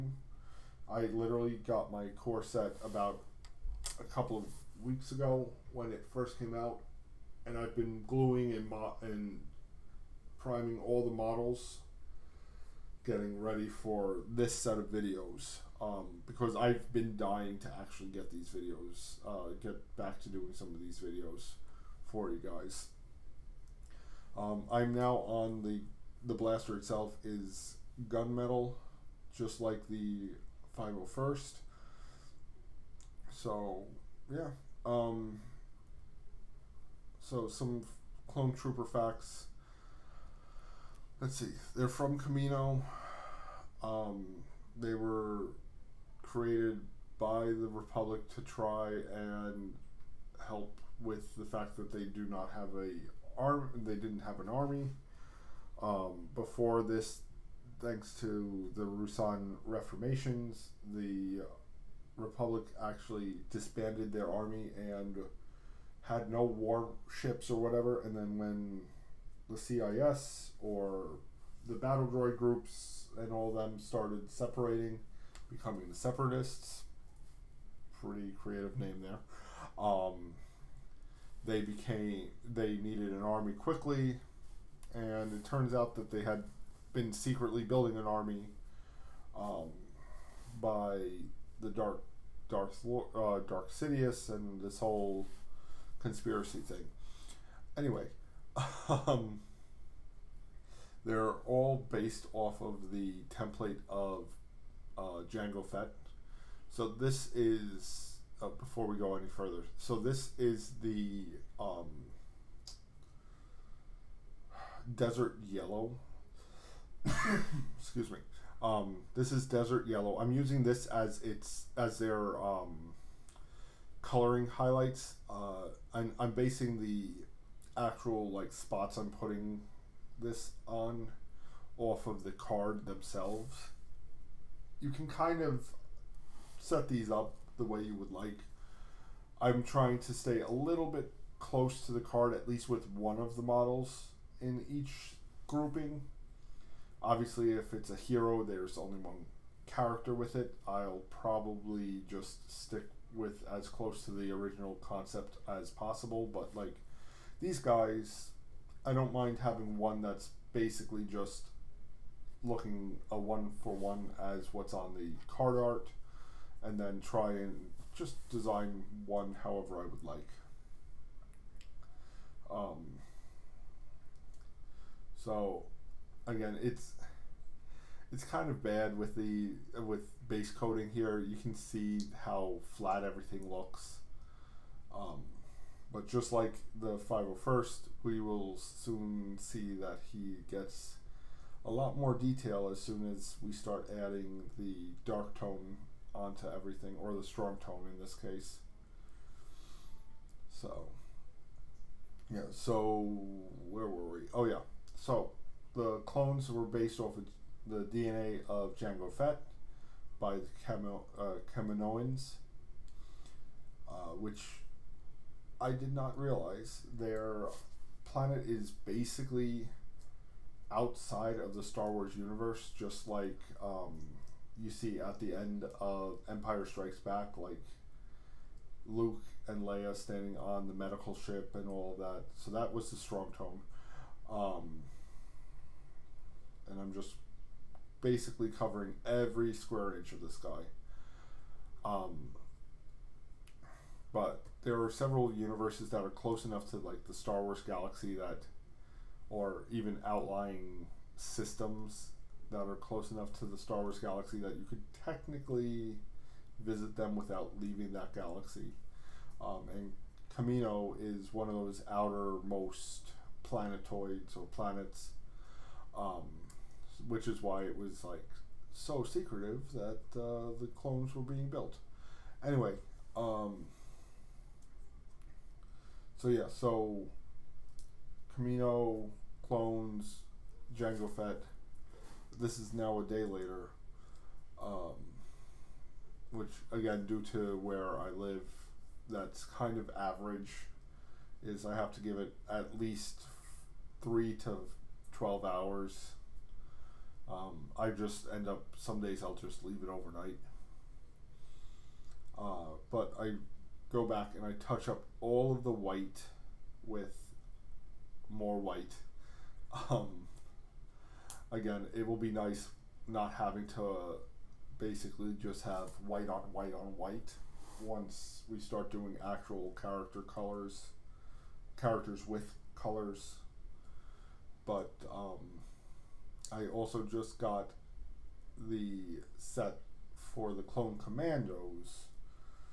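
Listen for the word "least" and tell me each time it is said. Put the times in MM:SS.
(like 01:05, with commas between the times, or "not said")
02:22, 04:52.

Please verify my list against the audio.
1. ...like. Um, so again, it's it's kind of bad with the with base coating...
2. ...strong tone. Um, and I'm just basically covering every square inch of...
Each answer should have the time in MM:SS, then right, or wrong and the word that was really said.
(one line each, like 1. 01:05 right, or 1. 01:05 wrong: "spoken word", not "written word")
1. 02:50 right
2. 03:52 right.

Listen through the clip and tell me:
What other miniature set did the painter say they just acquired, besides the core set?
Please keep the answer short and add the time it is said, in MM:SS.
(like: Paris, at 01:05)
Clone Commandos, at 05:30.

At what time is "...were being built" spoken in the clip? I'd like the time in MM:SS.
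04:31.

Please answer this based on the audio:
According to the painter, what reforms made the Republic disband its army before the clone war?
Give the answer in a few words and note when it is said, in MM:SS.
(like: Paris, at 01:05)
Ruusan reformations, at 00:58.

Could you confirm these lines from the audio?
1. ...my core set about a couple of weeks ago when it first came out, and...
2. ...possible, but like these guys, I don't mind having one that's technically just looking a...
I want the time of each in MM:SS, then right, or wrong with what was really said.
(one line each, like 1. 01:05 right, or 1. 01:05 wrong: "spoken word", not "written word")
1. 00:01 right
2. 02:35 wrong: "basically", not "technically".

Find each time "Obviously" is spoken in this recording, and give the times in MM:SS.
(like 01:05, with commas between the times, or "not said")
02:27.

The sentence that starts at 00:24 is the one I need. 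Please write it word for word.
Um, I'm now on the the blaster itself is gunmetal, just like the 501st.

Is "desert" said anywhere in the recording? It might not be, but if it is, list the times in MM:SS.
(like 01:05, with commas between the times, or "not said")
01:54, 01:59.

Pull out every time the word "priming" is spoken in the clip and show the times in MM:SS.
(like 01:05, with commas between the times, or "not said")
00:10.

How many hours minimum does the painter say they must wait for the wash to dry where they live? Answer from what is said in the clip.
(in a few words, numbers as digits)
3.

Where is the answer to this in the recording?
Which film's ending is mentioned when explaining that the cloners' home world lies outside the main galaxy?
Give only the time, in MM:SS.
03:46.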